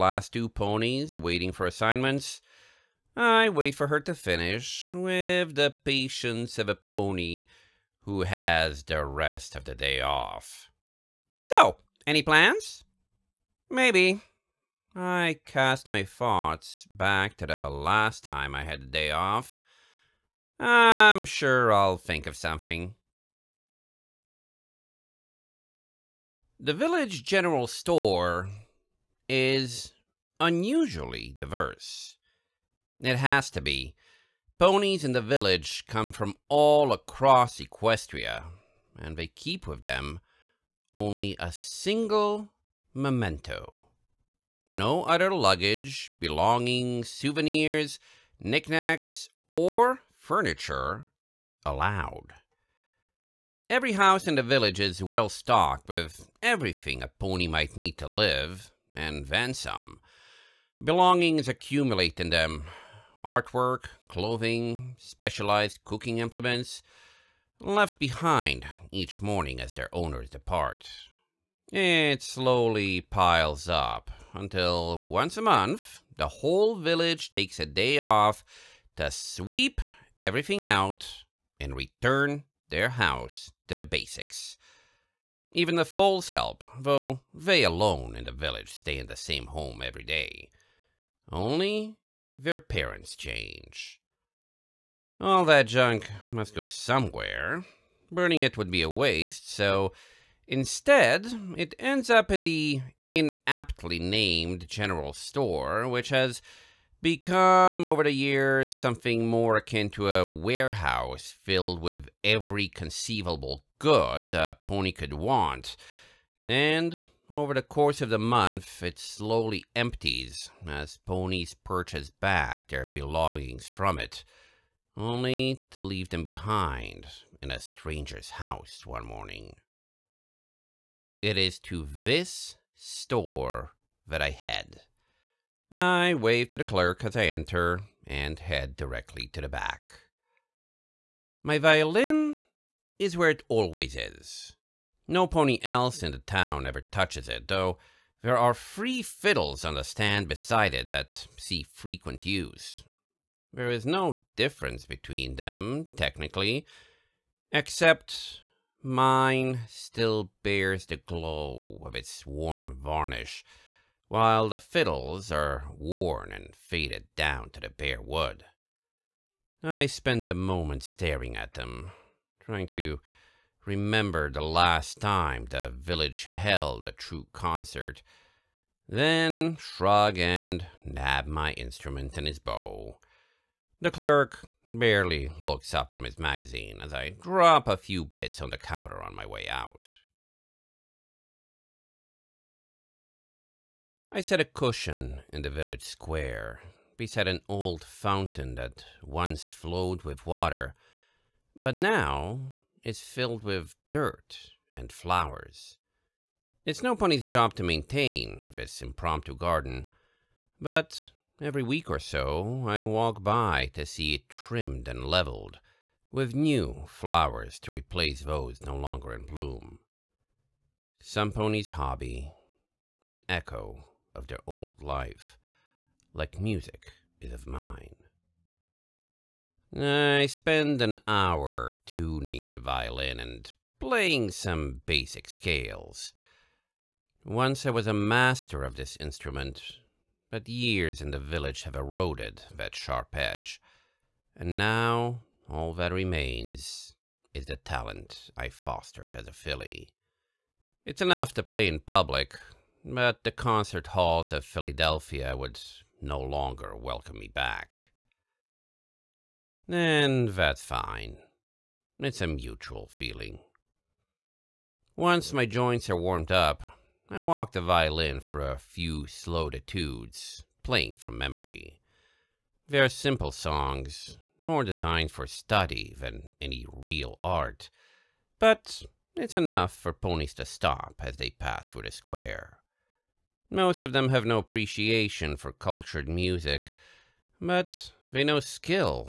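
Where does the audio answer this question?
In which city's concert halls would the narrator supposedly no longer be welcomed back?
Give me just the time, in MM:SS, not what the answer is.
04:14.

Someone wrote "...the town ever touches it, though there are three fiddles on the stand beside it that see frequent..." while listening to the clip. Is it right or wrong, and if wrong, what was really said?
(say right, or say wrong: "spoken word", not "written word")
right.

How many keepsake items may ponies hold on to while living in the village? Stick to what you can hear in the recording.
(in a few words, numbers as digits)
1.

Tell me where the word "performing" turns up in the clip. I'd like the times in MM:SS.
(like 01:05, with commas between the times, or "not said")
not said.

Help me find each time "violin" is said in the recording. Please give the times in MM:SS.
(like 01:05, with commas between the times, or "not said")
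02:21, 03:52, 04:27.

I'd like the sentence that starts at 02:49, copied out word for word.
I spend a moment staring at them, trying to Remember the last time the village held a true concert.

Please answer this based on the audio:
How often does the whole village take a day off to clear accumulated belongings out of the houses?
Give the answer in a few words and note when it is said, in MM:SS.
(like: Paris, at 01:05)
Once a month, at 01:15.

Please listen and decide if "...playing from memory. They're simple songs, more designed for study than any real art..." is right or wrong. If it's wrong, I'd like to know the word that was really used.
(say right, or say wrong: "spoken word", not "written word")
right.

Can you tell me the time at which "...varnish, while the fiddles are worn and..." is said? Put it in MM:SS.
02:42.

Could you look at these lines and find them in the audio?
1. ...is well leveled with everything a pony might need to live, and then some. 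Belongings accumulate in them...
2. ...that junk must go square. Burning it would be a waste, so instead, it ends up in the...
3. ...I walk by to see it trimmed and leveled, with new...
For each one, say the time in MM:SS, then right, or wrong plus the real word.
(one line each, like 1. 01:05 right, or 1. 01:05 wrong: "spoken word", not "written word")
1. 00:54 wrong: "stocked", not "leveled"
2. 01:35 wrong: "somewhere", not "square"
3. 03:32 right.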